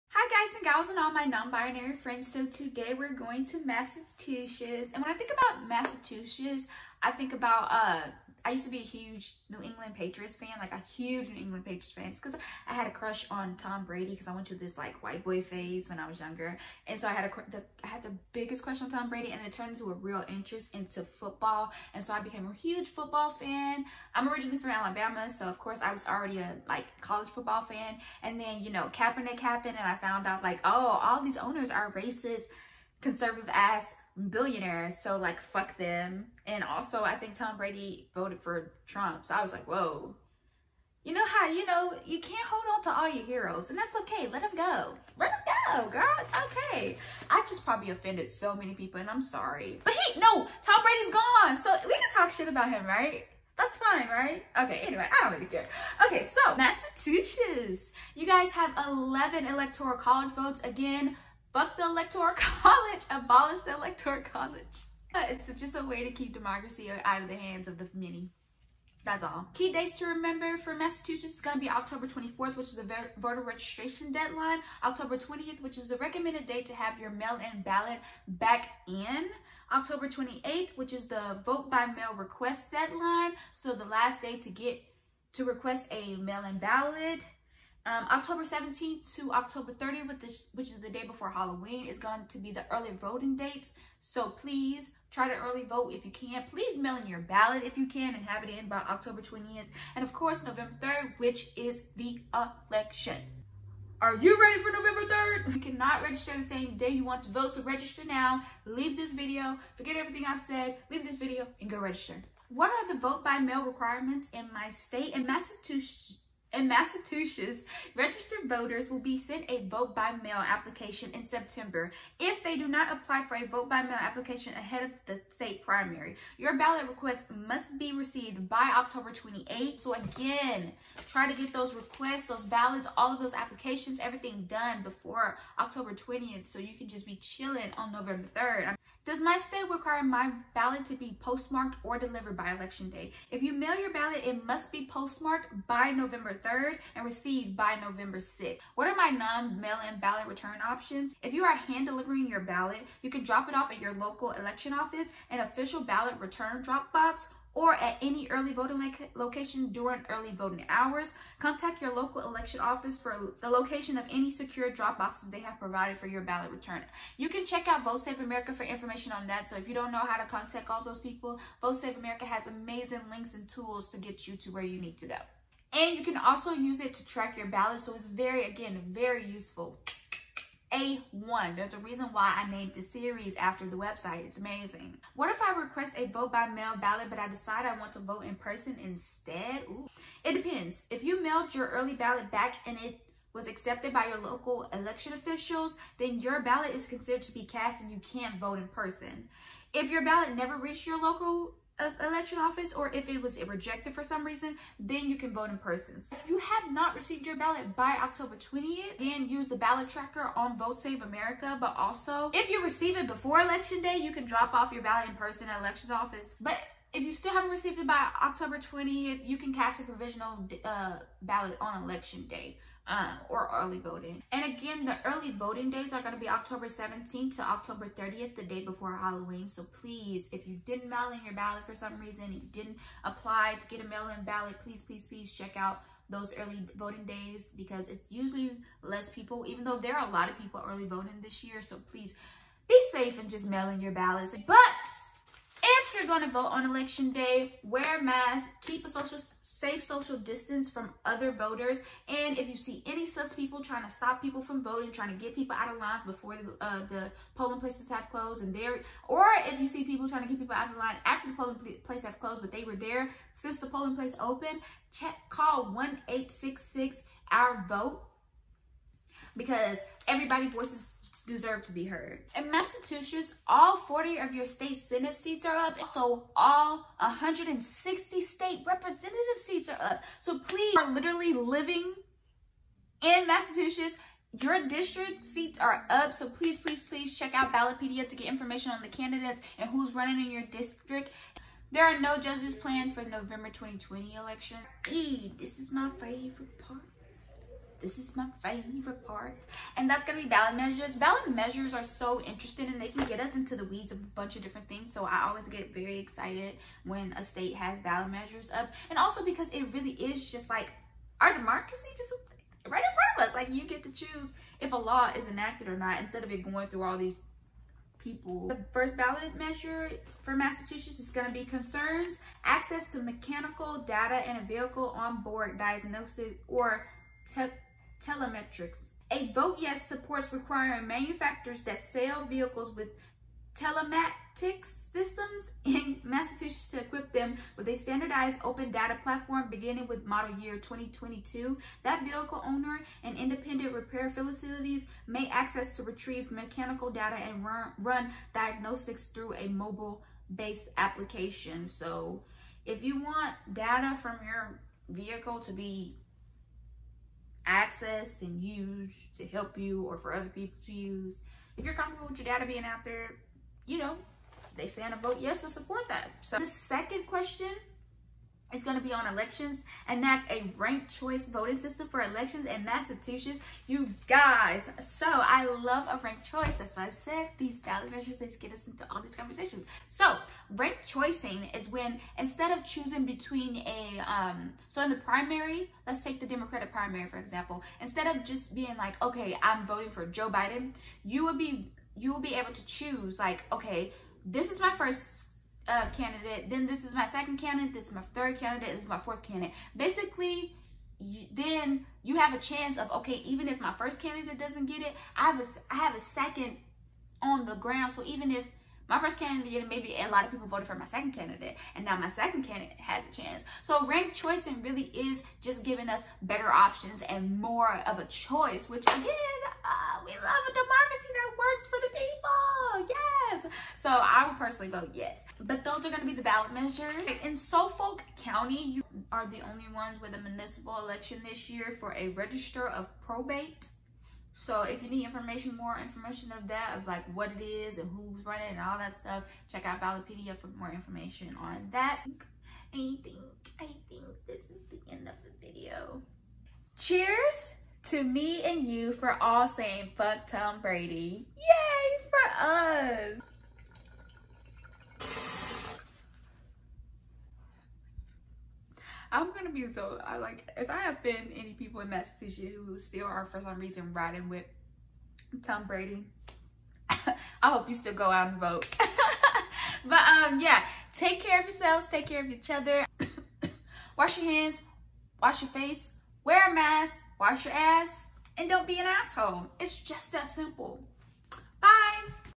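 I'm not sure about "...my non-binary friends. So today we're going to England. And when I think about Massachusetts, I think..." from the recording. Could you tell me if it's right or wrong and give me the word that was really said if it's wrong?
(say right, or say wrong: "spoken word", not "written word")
wrong: "Massachusetts", not "England".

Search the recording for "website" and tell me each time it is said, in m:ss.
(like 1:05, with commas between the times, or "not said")
3:03.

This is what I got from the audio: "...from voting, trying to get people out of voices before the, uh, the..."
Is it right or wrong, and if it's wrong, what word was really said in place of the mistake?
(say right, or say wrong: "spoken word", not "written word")
wrong: "lines", not "voices".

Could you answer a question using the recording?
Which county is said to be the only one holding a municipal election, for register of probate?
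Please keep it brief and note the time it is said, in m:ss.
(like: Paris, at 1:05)
Suffolk County, at 7:07.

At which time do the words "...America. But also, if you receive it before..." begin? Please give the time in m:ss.
3:31.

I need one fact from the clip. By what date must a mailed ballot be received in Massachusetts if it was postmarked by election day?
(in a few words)
November 6th.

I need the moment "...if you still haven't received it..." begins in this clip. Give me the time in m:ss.
3:36.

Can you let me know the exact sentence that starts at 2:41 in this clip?
Contact your local election office for the location of any secure drop boxes they have provided for your ballot return.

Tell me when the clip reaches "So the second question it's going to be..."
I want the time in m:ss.
6:06.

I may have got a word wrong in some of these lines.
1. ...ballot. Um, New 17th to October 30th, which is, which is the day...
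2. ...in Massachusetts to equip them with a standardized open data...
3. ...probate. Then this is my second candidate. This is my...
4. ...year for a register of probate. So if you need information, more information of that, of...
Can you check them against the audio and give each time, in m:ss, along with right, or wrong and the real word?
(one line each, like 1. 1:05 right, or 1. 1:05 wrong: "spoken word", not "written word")
1. 1:26 wrong: "October", not "New"
2. 5:35 right
3. 6:35 wrong: "candidate", not "probate"
4. 7:11 right.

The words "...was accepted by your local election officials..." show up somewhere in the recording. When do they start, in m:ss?
3:13.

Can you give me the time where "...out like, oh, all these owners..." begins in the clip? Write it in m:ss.
0:30.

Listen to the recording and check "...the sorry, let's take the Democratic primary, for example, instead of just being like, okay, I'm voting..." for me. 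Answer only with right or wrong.
wrong.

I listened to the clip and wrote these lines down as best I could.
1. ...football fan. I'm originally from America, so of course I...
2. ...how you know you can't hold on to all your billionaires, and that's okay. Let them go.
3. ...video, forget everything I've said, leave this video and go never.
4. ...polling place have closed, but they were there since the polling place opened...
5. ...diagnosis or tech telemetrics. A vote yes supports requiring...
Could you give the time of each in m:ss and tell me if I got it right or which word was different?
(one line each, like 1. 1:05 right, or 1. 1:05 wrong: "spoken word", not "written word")
1. 0:22 wrong: "Alabama", not "America"
2. 0:41 wrong: "heroes", not "billionaires"
3. 1:49 wrong: "register", not "never"
4. 4:21 right
5. 5:25 right.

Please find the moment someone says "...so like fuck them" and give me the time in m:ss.
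0:34.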